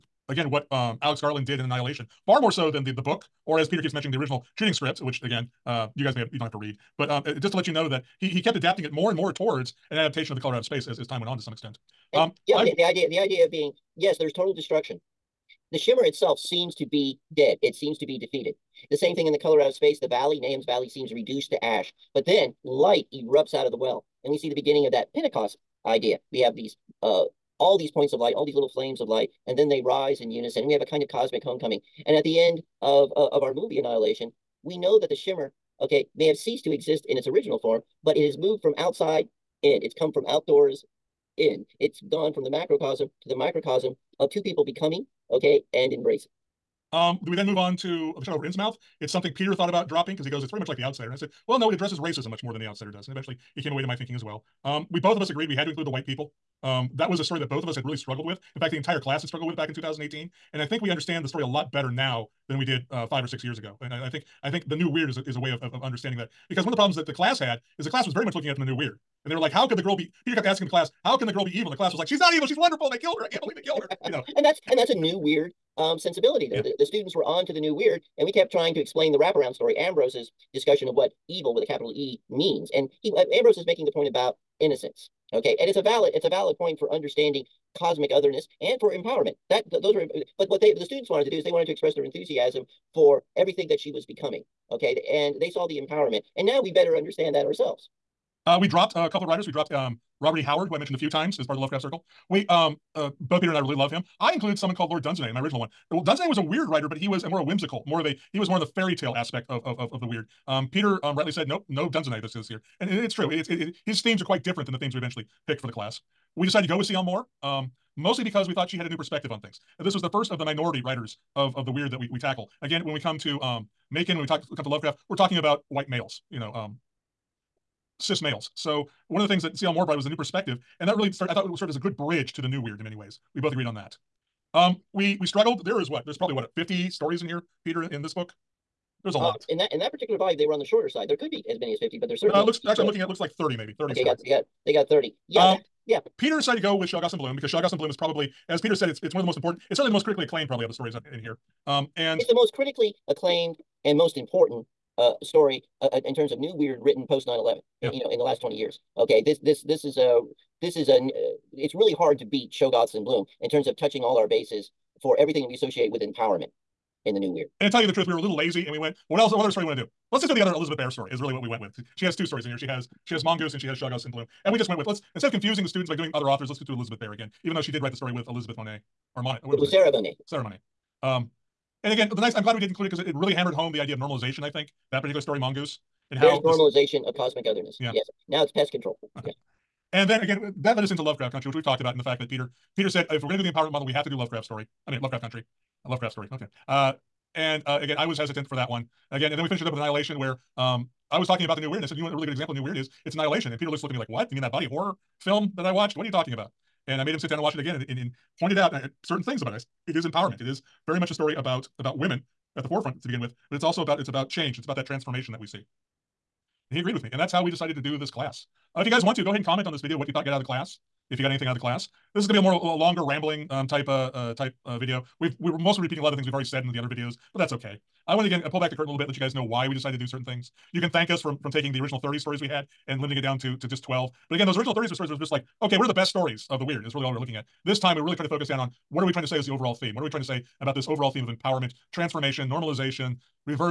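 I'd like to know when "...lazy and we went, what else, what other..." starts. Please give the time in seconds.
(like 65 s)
168 s.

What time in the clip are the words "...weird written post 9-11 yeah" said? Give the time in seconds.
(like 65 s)
156 s.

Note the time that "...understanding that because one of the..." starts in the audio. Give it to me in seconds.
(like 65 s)
65 s.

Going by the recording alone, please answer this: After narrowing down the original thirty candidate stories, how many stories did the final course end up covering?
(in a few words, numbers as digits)
12.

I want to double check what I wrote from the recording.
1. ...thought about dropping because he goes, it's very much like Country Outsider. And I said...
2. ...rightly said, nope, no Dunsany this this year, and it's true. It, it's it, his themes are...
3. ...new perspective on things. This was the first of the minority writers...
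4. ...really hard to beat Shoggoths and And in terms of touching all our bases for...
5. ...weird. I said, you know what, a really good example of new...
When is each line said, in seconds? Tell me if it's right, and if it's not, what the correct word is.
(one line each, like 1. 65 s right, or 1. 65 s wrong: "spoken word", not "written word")
1. 49 s wrong: "The", not "Country"
2. 111 s right
3. 118 s right
4. 161 s wrong: "Bloom", not "And"
5. 201 s right.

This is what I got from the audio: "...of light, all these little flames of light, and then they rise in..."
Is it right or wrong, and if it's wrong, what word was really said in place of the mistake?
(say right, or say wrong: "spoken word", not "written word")
right.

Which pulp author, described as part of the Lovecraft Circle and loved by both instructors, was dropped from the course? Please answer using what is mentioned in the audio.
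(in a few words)
Robert E. Howard.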